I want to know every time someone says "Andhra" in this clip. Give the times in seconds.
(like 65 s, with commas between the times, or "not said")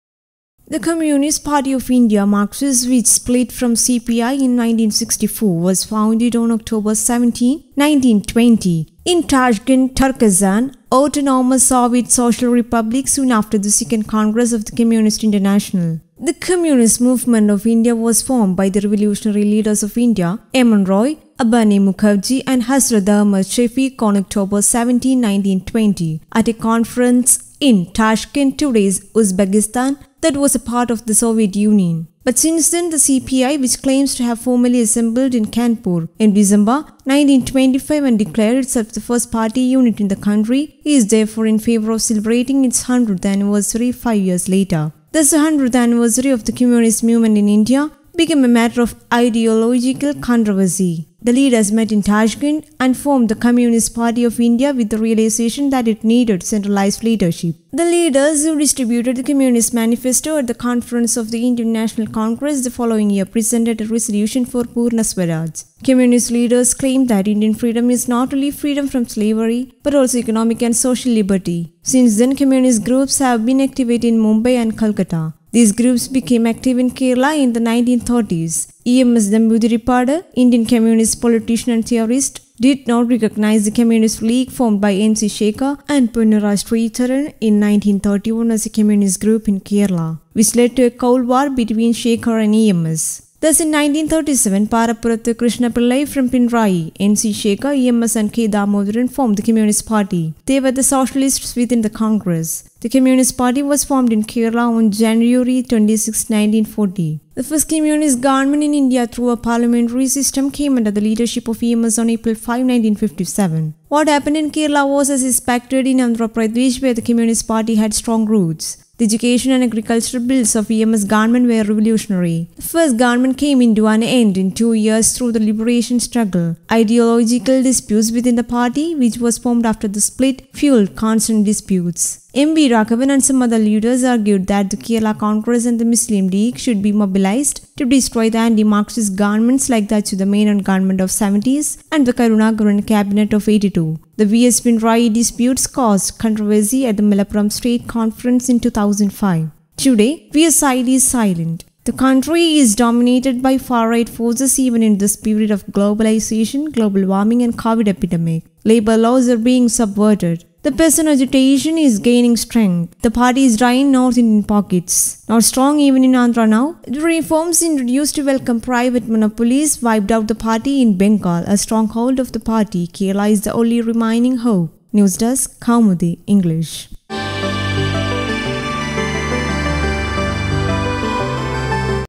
115 s, 166 s.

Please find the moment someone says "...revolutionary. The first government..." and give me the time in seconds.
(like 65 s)
121 s.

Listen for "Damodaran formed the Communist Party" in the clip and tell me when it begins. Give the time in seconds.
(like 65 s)
98 s.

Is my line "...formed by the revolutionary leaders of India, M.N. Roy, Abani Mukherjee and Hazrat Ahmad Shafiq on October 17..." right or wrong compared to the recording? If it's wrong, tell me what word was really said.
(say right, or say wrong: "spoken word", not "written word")
right.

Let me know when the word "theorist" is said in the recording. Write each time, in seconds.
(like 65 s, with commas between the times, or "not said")
81 s.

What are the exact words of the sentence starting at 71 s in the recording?
Since then, communist groups have been active in Mumbai and Calcutta.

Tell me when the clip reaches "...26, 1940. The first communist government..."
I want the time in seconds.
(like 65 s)
105 s.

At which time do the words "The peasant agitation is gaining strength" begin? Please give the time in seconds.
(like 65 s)
160 s.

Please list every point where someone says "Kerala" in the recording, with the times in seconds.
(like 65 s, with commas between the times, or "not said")
76 s, 89 s, 104 s, 114 s, 134 s, 172 s.